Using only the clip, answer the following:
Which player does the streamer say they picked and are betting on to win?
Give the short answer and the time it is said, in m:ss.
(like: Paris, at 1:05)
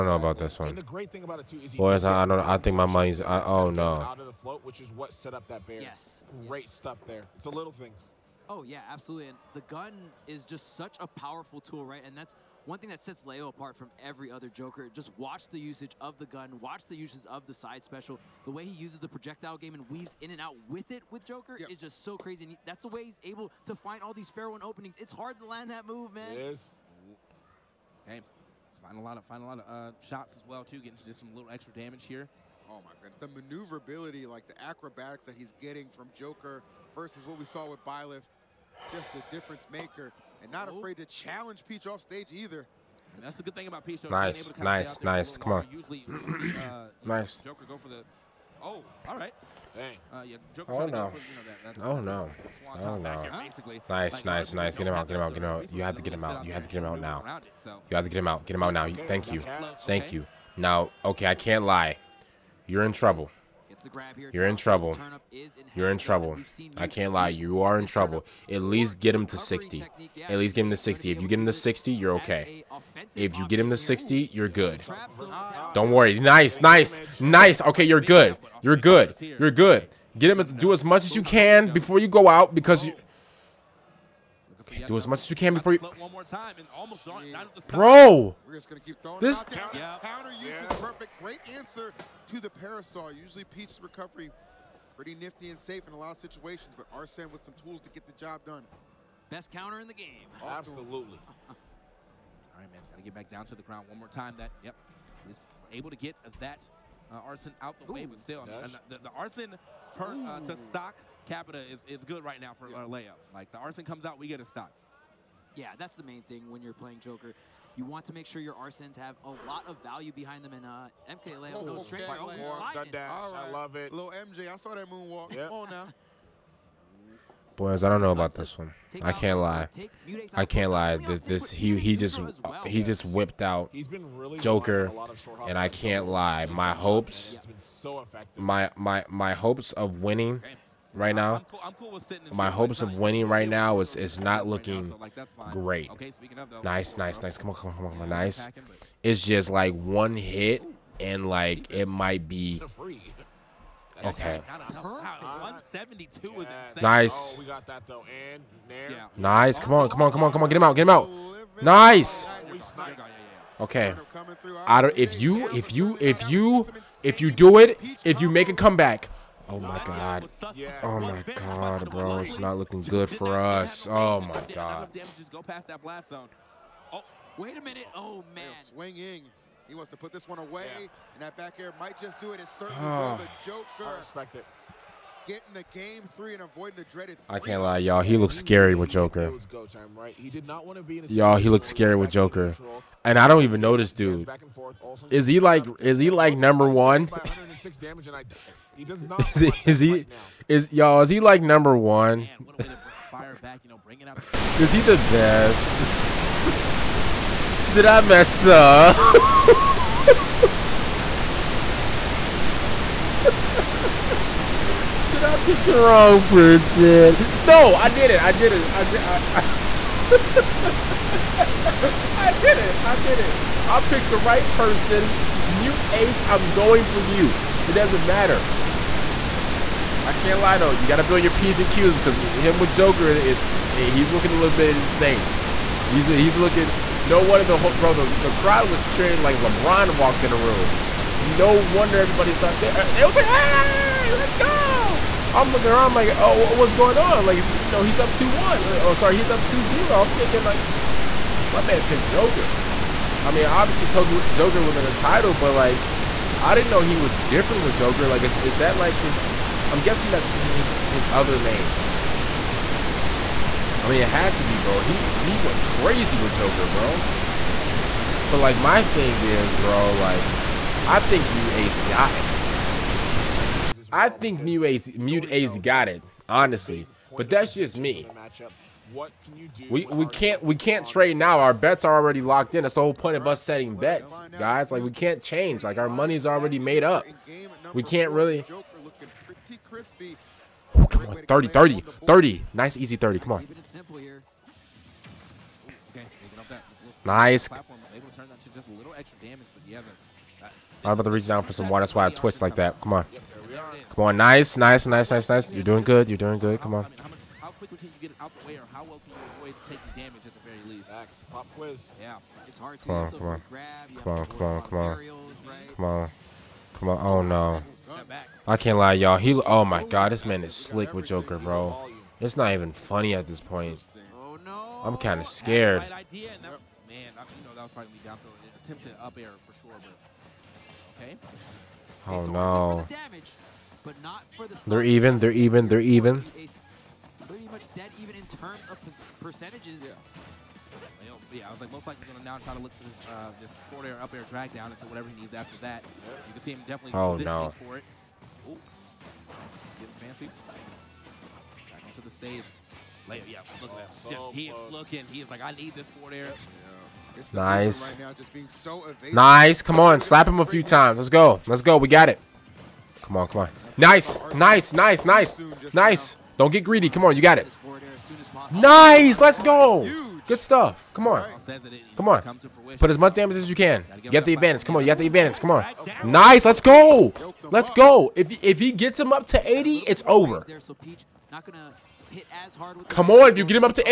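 Mute Ace, at 3:45.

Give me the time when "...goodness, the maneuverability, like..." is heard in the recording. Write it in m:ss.
0:33.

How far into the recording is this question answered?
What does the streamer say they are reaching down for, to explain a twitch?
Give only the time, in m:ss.
5:01.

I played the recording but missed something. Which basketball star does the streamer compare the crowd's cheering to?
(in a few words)
LeBron.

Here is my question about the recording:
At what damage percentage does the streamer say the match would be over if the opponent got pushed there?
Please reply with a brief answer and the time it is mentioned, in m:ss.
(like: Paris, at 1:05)
80, at 6:19.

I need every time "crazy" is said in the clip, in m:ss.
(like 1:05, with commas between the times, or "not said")
0:22, 4:25.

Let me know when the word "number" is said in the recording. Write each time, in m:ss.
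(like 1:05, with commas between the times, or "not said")
3:16, 3:21.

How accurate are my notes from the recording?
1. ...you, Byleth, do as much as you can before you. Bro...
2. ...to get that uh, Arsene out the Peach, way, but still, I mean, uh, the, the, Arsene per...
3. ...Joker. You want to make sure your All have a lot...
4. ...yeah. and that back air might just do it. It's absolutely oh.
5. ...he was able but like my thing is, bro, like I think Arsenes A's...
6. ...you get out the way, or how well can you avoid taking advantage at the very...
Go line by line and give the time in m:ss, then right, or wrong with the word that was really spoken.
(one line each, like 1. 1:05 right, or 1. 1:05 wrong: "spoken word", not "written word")
1. 1:22 wrong: "Okay", not "Byleth"
2. 1:45 wrong: "Ooh", not "Peach"
3. 1:56 wrong: "Arsenes", not "All"
4. 3:00 wrong: "certainly", not "absolutely"
5. 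4:27 wrong: "Mew", not "Arsenes"
6. 5:08 wrong: "damage", not "advantage".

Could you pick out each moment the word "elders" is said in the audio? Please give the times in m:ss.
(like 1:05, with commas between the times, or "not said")
not said.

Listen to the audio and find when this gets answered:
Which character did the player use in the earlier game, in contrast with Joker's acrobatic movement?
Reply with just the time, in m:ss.
0:37.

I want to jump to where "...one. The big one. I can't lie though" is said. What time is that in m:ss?
3:49.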